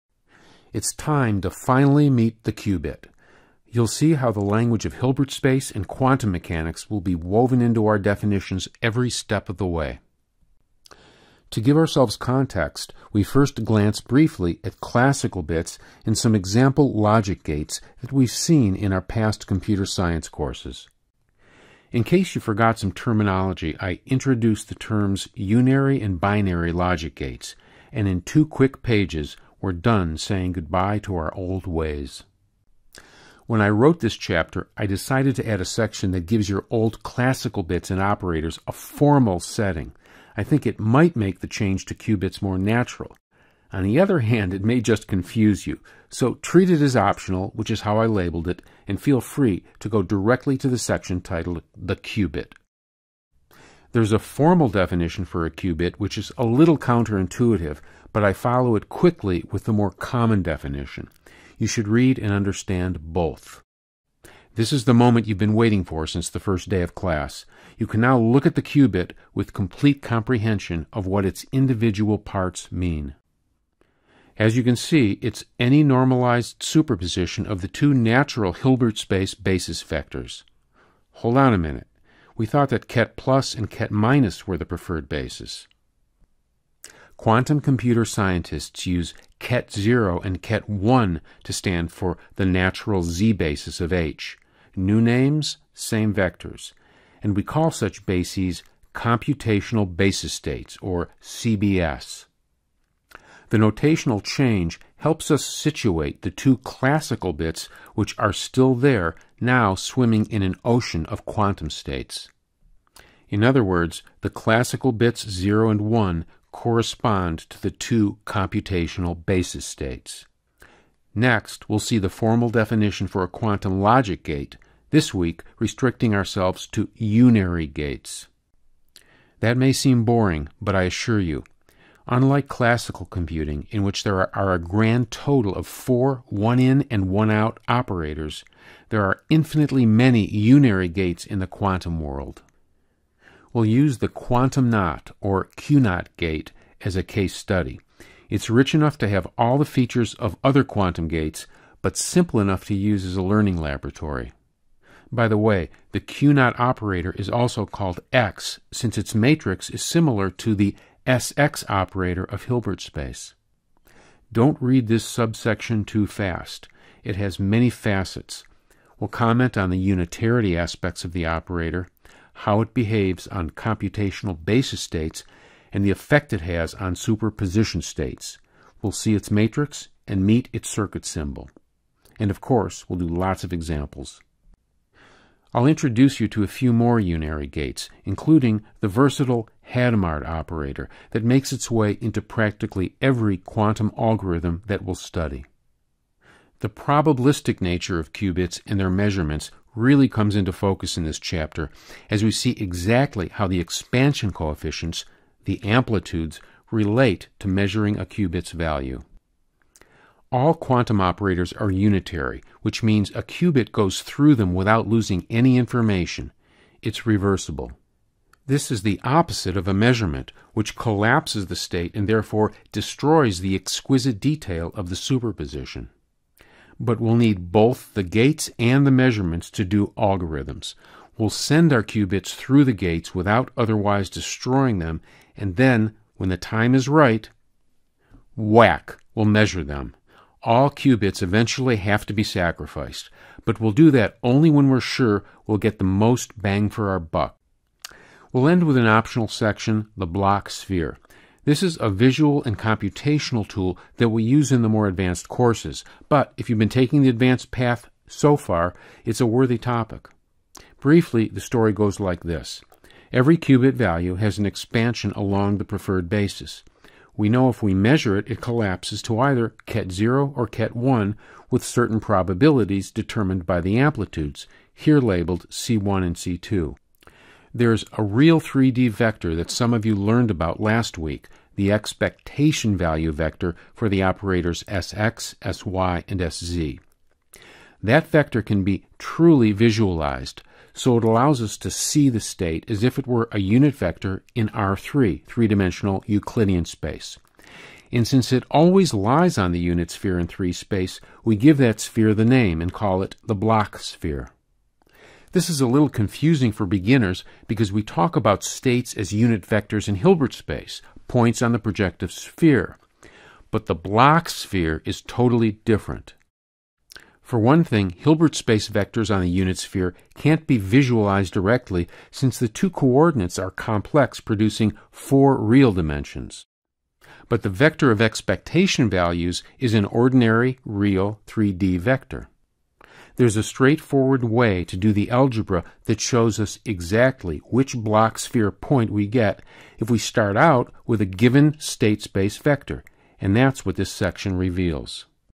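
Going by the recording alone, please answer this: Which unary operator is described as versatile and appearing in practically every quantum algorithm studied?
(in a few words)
Hadamard operator.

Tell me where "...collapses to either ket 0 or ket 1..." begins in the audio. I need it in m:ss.
4:28.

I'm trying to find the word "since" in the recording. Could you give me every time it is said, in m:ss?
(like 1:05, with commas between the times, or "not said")
1:06, 2:38, 4:58, 5:22.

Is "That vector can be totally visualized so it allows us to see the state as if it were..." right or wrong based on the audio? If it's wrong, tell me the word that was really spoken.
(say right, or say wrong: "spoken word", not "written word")
wrong: "truly", not "totally".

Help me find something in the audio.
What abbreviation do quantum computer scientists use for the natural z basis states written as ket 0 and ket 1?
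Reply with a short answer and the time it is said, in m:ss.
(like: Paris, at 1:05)
CBS, at 1:41.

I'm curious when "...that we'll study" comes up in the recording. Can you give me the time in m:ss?
3:14.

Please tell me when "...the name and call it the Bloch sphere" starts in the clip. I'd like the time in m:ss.
5:02.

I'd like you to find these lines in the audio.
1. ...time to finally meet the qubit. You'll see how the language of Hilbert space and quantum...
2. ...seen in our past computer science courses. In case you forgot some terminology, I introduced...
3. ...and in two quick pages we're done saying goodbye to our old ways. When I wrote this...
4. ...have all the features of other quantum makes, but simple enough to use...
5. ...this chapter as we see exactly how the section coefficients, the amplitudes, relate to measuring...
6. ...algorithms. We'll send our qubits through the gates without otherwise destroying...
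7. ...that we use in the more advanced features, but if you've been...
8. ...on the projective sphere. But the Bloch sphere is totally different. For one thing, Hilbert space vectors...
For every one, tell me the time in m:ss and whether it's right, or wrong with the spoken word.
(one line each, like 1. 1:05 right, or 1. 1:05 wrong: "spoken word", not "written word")
1. 0:00 right
2. 0:18 right
3. 0:27 right
4. 2:29 wrong: "gates", not "makes"
5. 3:21 wrong: "expansion", not "section"
6. 3:49 right
7. 4:13 wrong: "courses", not "features"
8. 5:11 right.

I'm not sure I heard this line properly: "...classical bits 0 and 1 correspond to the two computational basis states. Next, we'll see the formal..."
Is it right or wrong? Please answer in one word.
right.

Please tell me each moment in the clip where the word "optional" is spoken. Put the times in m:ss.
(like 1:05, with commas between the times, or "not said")
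0:46, 4:08.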